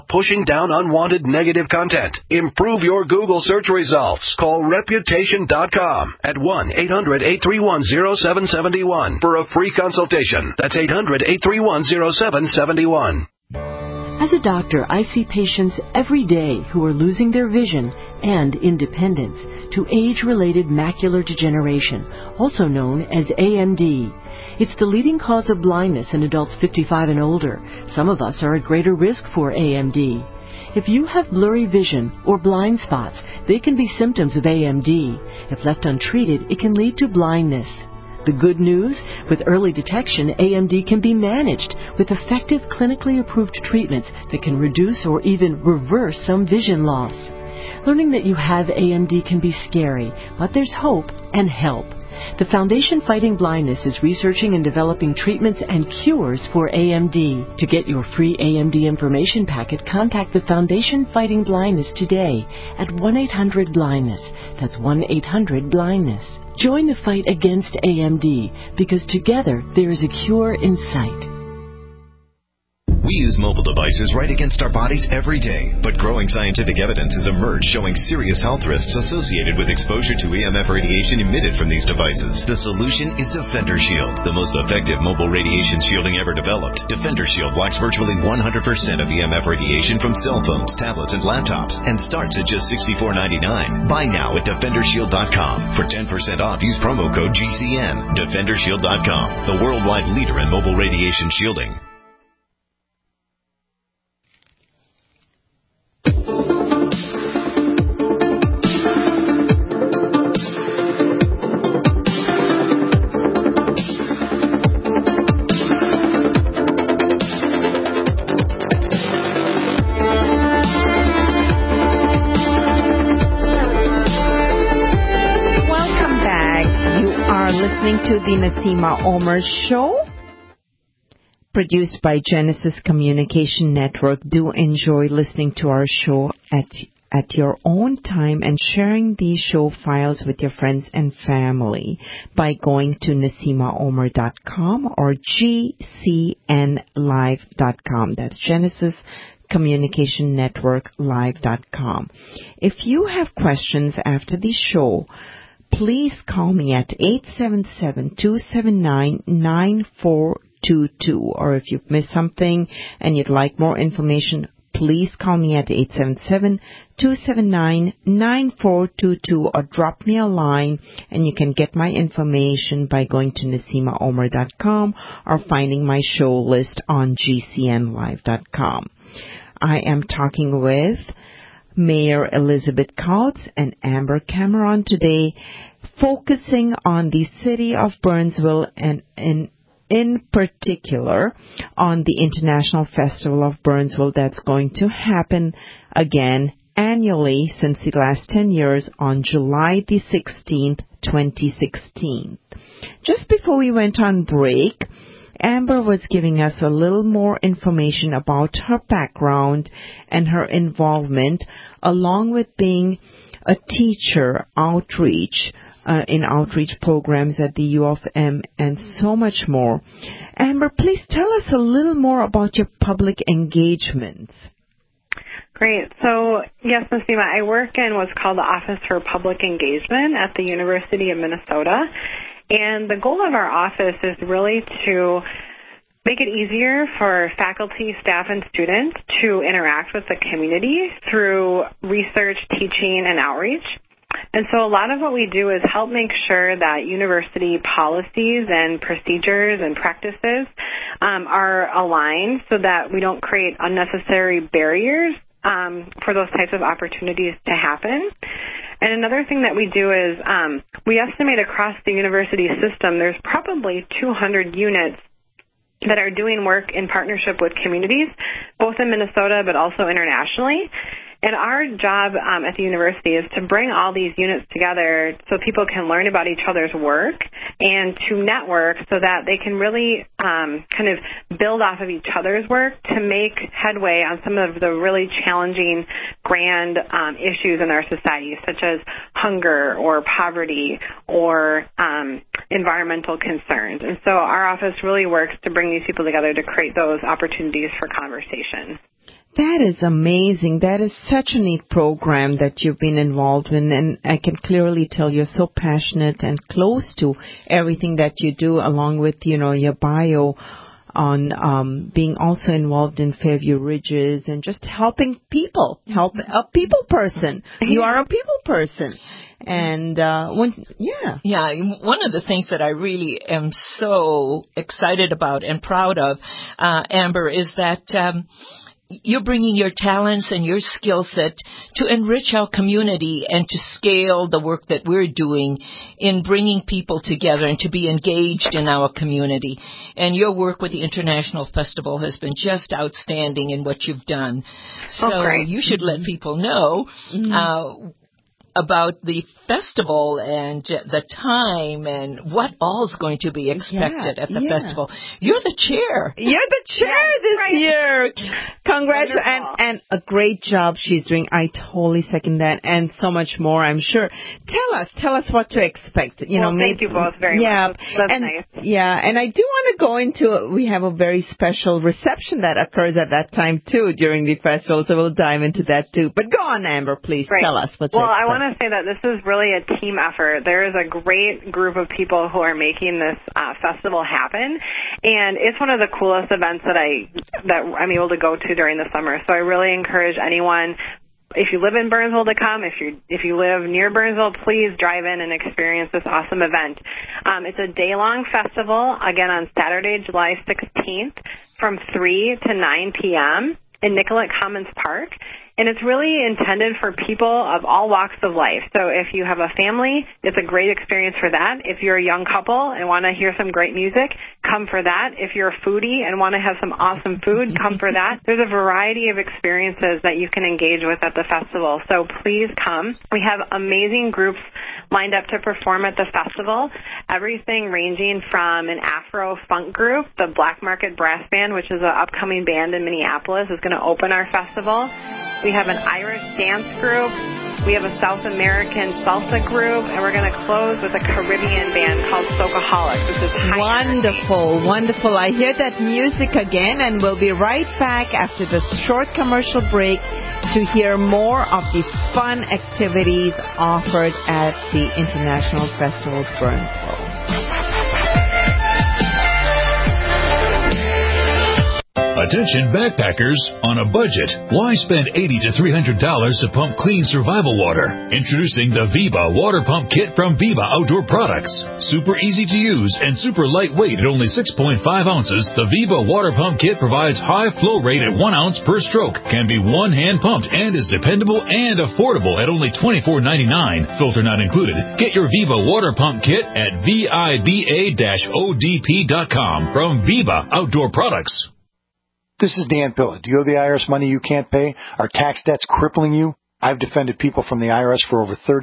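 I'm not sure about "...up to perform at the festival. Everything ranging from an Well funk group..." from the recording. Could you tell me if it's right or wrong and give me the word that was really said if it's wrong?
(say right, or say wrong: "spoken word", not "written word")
wrong: "Afro", not "Well".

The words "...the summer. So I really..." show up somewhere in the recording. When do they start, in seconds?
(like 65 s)
388 s.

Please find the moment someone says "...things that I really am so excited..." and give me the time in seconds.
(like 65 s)
322 s.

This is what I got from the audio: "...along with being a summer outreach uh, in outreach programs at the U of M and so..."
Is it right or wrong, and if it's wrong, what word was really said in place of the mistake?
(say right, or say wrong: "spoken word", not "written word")
wrong: "teacher", not "summer".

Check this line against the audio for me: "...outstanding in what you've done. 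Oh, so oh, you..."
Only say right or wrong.
right.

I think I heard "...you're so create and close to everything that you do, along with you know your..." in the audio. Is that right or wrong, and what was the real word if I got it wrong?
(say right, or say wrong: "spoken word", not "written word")
wrong: "passionate", not "create".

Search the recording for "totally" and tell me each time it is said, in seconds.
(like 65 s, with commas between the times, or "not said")
361 s.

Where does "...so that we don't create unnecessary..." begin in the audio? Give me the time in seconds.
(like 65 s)
252 s.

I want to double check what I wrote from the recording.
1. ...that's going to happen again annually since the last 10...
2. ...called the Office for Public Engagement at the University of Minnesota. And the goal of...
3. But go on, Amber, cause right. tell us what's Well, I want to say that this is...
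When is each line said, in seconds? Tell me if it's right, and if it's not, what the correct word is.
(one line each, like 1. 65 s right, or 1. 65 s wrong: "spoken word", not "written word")
1. 194 s right
2. 228 s right
3. 376 s wrong: "please", not "cause".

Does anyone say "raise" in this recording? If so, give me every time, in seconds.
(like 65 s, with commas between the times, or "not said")
not said.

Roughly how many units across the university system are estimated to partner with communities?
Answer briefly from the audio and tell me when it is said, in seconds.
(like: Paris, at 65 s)
200, at 264 s.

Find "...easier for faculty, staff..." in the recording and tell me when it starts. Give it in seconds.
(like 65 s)
236 s.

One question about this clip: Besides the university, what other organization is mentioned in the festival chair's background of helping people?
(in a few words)
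Fairview Ridges.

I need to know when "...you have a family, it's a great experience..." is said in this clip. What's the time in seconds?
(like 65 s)
409 s.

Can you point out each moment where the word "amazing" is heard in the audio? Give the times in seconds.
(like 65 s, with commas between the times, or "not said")
299 s, 423 s.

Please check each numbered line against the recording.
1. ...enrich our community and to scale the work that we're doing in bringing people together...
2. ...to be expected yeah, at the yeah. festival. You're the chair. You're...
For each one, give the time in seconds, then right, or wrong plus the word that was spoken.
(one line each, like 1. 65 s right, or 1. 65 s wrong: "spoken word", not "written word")
1. 331 s right
2. 353 s right.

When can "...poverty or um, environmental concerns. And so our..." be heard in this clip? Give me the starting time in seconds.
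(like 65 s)
290 s.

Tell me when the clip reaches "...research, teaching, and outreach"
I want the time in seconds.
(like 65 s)
241 s.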